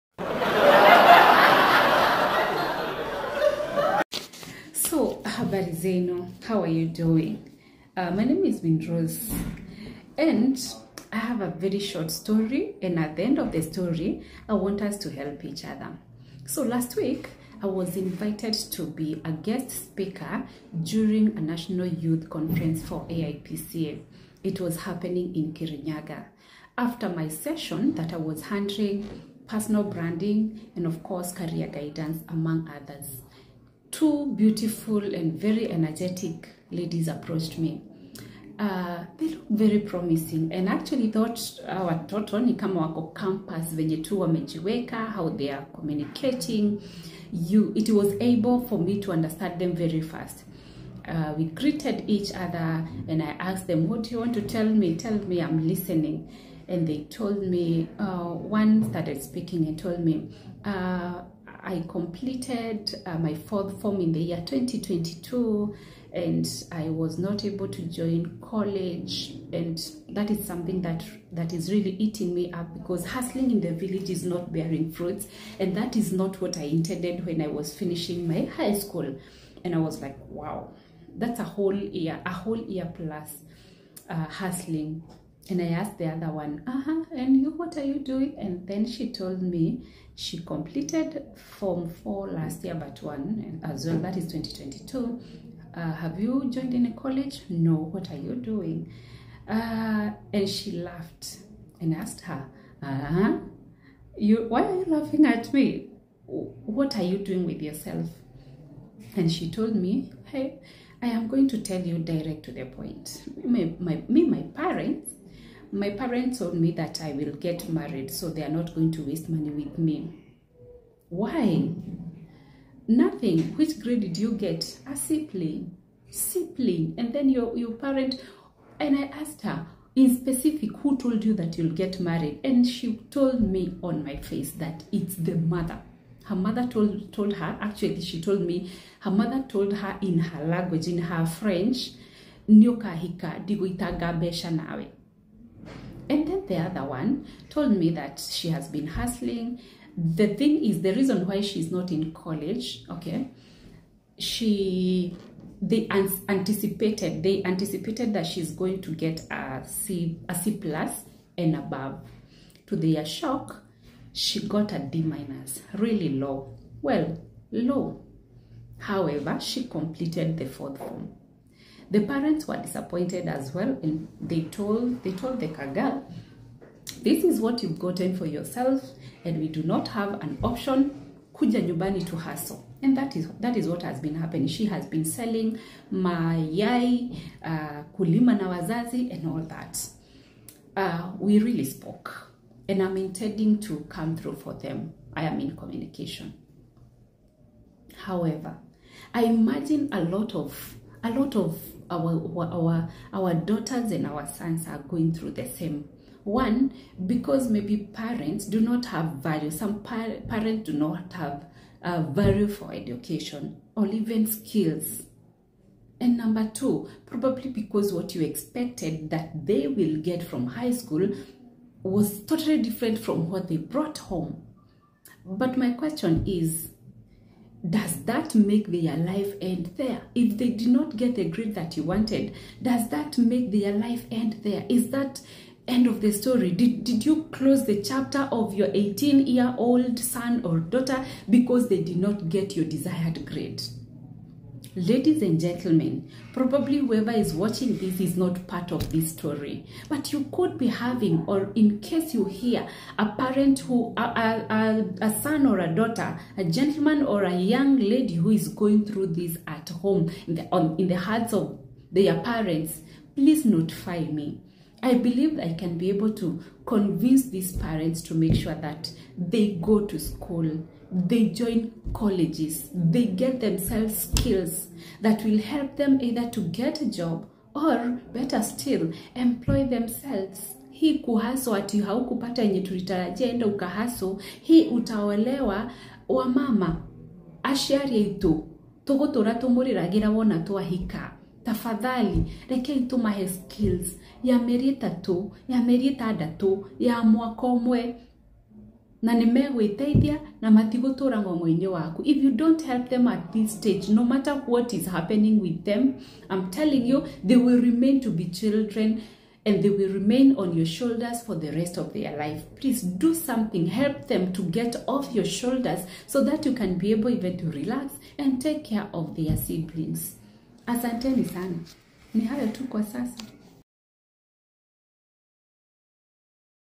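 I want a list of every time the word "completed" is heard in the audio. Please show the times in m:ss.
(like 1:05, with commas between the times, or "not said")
1:01, 1:30, 2:49.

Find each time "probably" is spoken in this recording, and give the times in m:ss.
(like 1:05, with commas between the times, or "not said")
3:37, 4:06.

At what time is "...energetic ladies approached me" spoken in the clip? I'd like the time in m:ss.
0:35.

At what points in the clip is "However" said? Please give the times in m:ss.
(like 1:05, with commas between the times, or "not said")
2:48, 3:18.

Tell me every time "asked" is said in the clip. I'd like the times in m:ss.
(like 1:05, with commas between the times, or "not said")
0:53, 1:25, 1:41, 2:09.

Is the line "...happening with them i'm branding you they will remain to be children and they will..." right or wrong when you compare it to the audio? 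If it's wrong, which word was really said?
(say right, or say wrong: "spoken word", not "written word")
wrong: "telling", not "branding".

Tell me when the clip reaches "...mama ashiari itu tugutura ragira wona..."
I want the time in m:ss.
4:46.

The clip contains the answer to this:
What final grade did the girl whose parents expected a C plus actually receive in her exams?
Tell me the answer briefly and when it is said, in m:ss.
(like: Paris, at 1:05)
D minus, at 2:44.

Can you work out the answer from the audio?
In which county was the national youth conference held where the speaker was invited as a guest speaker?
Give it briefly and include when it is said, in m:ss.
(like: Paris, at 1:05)
Kirinyaga, at 0:25.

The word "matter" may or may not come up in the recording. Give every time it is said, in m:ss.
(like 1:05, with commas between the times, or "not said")
5:04.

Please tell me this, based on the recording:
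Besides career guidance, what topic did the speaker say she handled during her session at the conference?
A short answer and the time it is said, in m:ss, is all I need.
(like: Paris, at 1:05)
Personal branding, at 0:29.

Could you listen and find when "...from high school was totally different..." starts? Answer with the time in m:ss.
3:40.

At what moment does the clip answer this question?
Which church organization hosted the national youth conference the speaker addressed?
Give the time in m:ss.
0:23.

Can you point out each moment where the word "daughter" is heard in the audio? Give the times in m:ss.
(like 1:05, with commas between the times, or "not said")
3:23, 4:00, 4:15.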